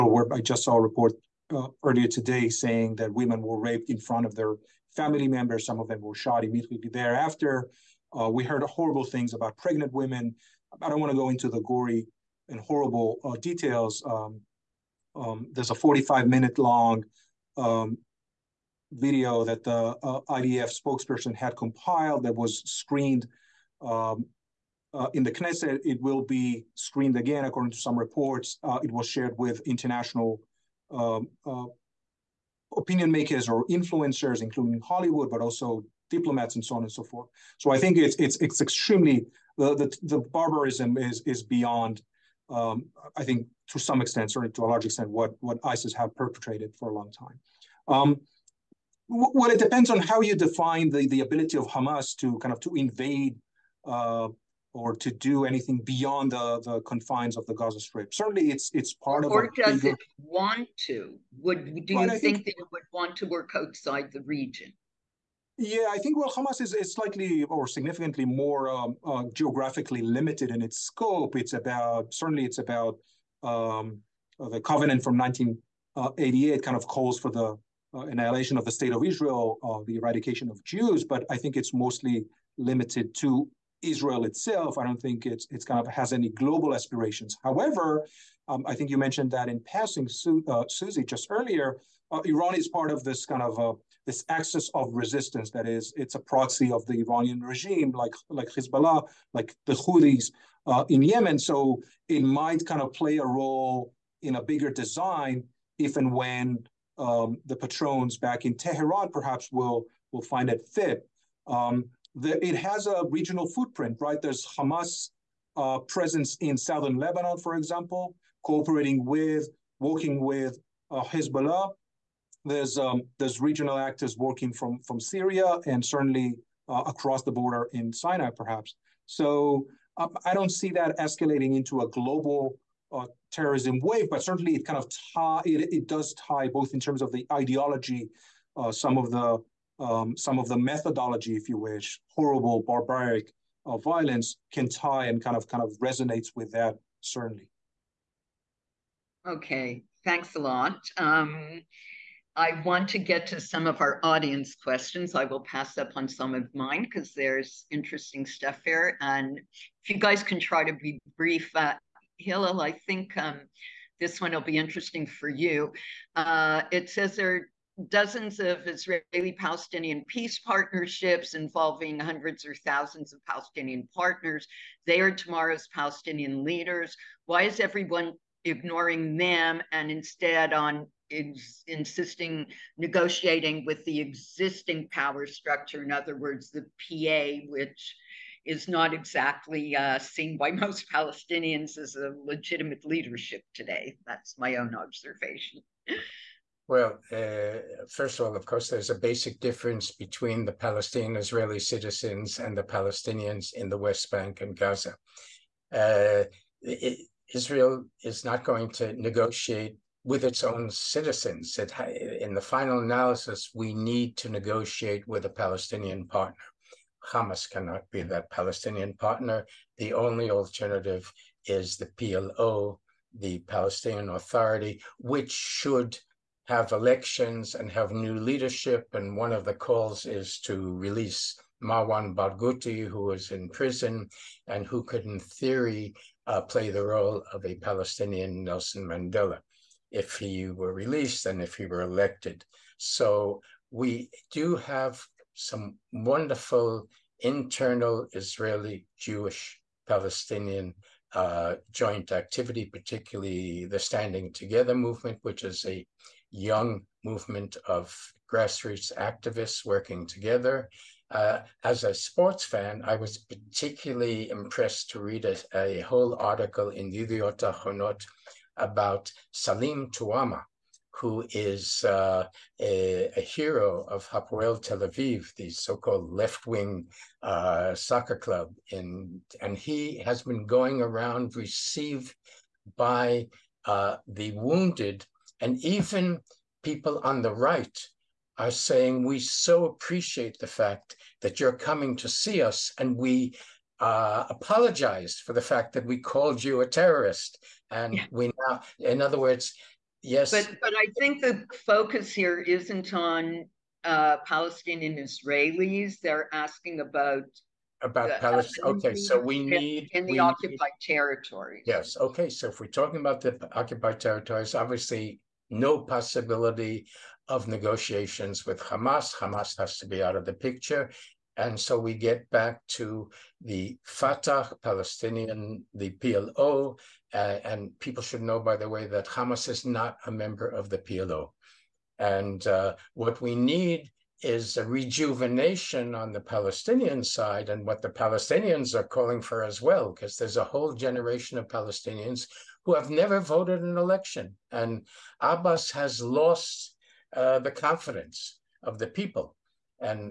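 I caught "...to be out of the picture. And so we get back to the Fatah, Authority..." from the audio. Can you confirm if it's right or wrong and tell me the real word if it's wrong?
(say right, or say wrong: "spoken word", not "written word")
wrong: "Palestinian", not "Authority".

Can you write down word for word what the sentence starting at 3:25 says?
Uh, it, Israel is not going to negotiate with its own citizens.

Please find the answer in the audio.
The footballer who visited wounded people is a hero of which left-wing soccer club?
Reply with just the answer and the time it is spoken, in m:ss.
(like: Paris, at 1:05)
Hapoel Tel Aviv, at 4:34.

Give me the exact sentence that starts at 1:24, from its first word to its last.
I don't think it's it's kind of has any global aspirations.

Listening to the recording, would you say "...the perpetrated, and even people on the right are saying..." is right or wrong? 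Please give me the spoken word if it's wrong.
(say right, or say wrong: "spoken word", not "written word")
wrong: "wounded", not "perpetrated".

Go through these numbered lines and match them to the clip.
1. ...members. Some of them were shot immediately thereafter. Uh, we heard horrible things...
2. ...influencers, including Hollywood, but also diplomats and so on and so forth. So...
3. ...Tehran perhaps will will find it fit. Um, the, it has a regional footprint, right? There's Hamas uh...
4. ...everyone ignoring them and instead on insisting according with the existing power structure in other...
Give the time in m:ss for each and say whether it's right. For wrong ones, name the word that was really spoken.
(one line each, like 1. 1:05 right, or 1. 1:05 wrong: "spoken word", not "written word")
1. 0:05 right
2. 0:33 right
3. 1:48 right
4. 2:57 wrong: "negotiating", not "according".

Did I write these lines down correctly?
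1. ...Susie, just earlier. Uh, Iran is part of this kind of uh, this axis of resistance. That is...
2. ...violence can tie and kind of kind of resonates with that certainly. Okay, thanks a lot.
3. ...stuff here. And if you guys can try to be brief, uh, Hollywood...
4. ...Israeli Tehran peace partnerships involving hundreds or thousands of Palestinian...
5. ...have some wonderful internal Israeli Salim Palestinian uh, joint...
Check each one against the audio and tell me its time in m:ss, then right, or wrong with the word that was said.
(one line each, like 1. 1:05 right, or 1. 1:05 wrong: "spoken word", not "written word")
1. 1:30 right
2. 2:23 right
3. 2:38 wrong: "Hillel", not "Hollywood"
4. 2:48 wrong: "Palestinian", not "Tehran"
5. 4:04 wrong: "Jewish", not "Salim".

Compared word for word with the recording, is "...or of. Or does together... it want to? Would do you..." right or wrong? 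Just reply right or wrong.
wrong.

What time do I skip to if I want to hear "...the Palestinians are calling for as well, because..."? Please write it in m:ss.
5:37.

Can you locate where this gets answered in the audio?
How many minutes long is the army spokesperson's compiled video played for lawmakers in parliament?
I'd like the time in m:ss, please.
0:15.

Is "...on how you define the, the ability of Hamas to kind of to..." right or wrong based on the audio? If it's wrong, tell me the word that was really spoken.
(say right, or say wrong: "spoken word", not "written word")
right.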